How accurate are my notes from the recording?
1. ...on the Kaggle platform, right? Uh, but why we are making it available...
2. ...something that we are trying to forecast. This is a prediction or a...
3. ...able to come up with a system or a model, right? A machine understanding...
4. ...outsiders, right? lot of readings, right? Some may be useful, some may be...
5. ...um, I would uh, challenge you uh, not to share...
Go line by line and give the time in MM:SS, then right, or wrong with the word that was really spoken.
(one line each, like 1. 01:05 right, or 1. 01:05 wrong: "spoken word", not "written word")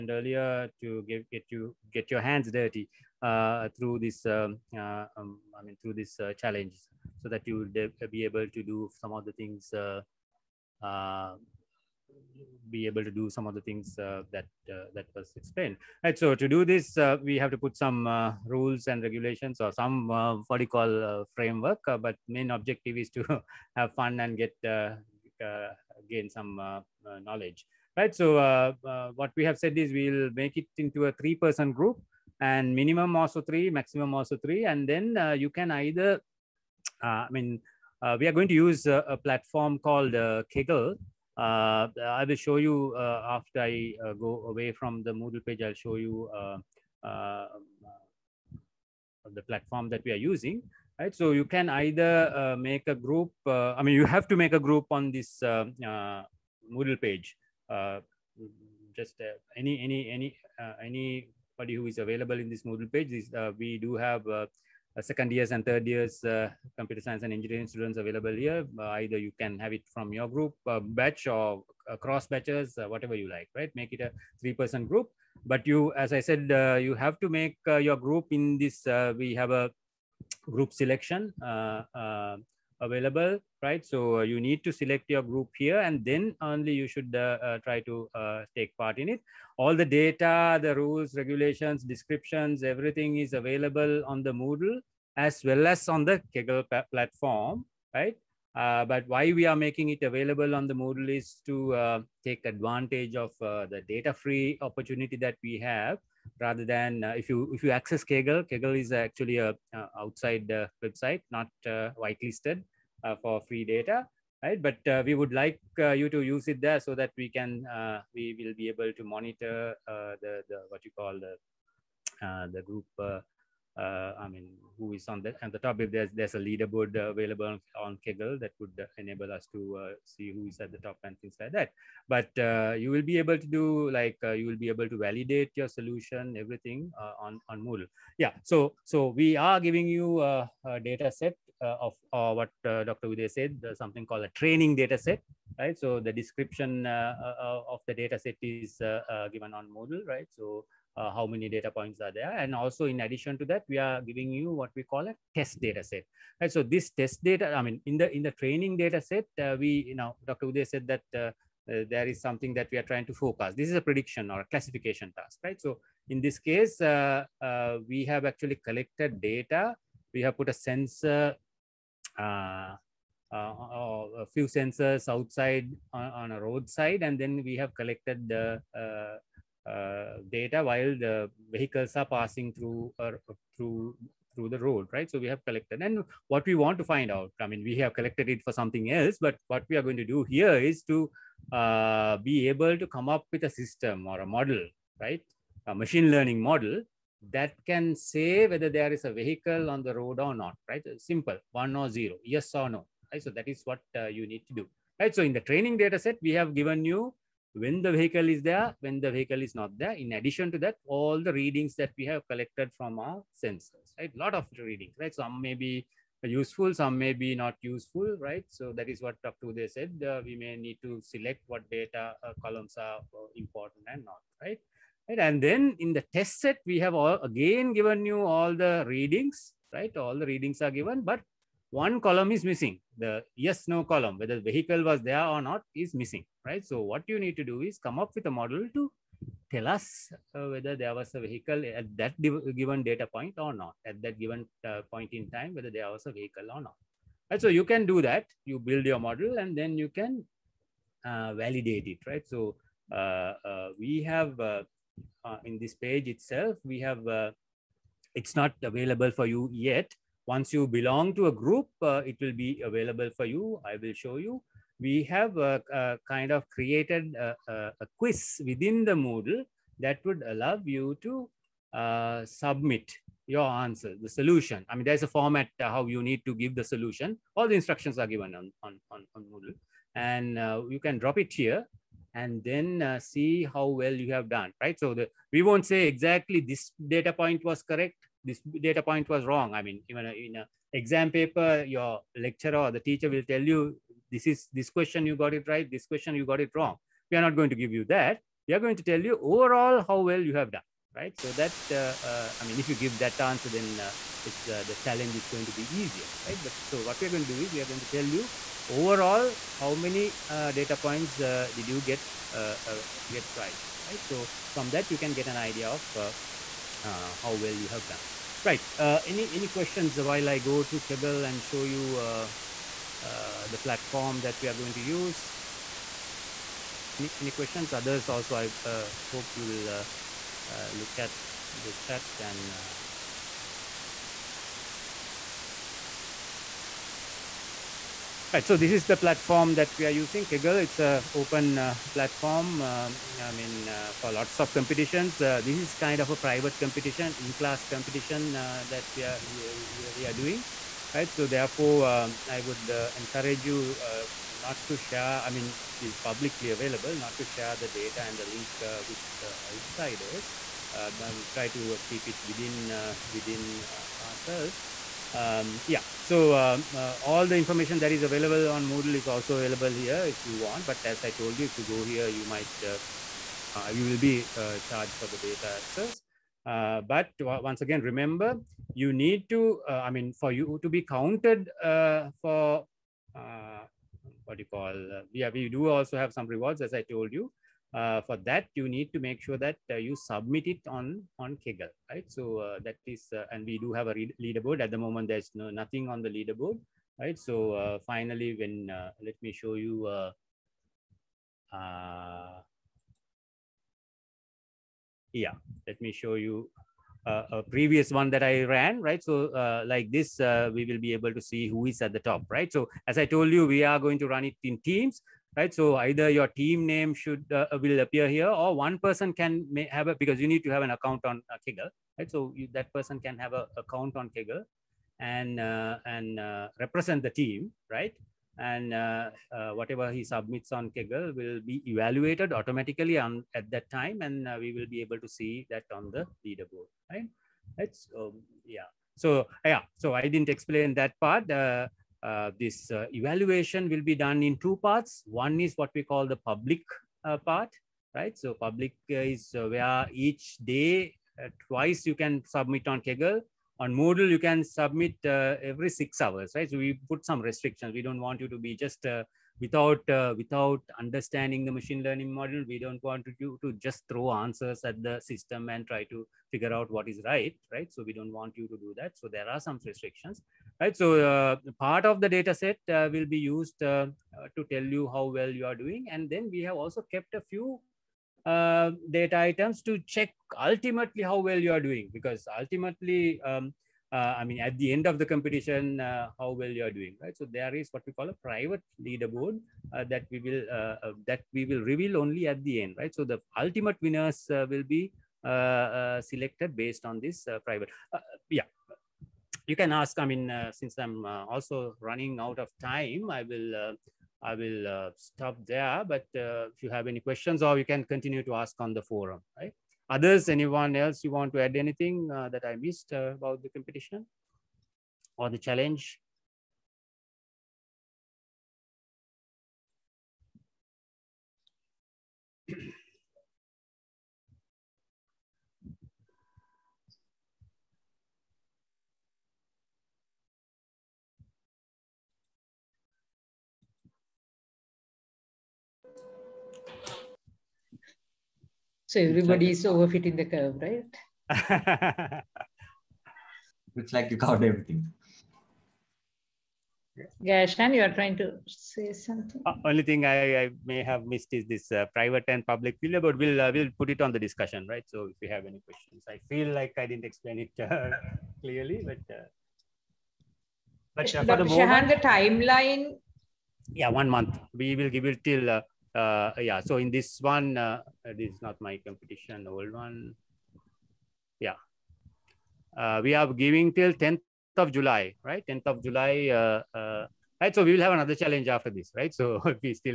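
1. 01:35 right
2. 02:42 right
3. 03:12 wrong: "learning", not "understanding"
4. 03:33 wrong: "sensors", not "outsiders"
5. 05:51 wrong: "encourage", not "challenge".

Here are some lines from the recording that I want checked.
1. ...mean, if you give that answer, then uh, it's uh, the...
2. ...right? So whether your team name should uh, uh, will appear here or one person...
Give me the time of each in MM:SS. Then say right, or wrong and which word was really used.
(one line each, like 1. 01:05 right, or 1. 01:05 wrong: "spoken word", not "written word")
1. 05:02 right
2. 06:55 wrong: "either", not "whether".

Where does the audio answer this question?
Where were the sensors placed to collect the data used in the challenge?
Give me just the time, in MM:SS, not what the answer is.
02:56.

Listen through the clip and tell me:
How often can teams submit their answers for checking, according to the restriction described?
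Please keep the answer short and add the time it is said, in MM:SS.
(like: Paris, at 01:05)
Every 6 hours, at 07:35.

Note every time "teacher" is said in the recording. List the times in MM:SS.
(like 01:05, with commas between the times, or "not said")
04:52.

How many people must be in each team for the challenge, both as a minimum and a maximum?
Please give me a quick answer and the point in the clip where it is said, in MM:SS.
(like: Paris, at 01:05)
3, at 00:31.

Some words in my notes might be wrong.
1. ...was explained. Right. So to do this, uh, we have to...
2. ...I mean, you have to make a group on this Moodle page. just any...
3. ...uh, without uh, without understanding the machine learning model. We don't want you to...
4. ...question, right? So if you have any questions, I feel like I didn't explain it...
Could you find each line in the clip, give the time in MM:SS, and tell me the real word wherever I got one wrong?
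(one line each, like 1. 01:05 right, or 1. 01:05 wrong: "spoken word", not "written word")
1. 00:15 right
2. 00:53 right
3. 07:38 right
4. 09:14 wrong: "discussion", not "question".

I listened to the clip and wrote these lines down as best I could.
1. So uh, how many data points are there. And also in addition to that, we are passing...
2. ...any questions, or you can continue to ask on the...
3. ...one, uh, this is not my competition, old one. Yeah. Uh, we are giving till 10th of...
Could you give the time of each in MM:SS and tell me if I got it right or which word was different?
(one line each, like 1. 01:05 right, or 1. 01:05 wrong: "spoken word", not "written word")
1. 02:30 wrong: "giving", not "passing"
2. 08:26 right
3. 09:27 right.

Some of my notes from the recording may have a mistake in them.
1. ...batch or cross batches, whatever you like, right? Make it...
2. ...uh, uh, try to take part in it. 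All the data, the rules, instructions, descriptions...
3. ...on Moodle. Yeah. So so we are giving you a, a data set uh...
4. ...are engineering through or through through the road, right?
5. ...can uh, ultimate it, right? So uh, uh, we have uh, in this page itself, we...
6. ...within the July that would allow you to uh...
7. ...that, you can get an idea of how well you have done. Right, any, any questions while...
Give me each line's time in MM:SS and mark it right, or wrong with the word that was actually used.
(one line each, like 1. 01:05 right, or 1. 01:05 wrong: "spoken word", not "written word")
1. 01:10 right
2. 01:27 wrong: "regulations", not "instructions"
3. 02:17 right
4. 03:01 wrong: "passing", not "engineering"
5. 04:09 wrong: "validate", not "ultimate"
6. 04:28 wrong: "Moodle", not "July"
7. 05:14 right.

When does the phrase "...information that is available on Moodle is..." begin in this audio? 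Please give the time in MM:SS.
06:07.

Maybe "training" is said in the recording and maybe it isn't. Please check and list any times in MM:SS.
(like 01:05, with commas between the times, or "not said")
02:24, 02:38, 03:25.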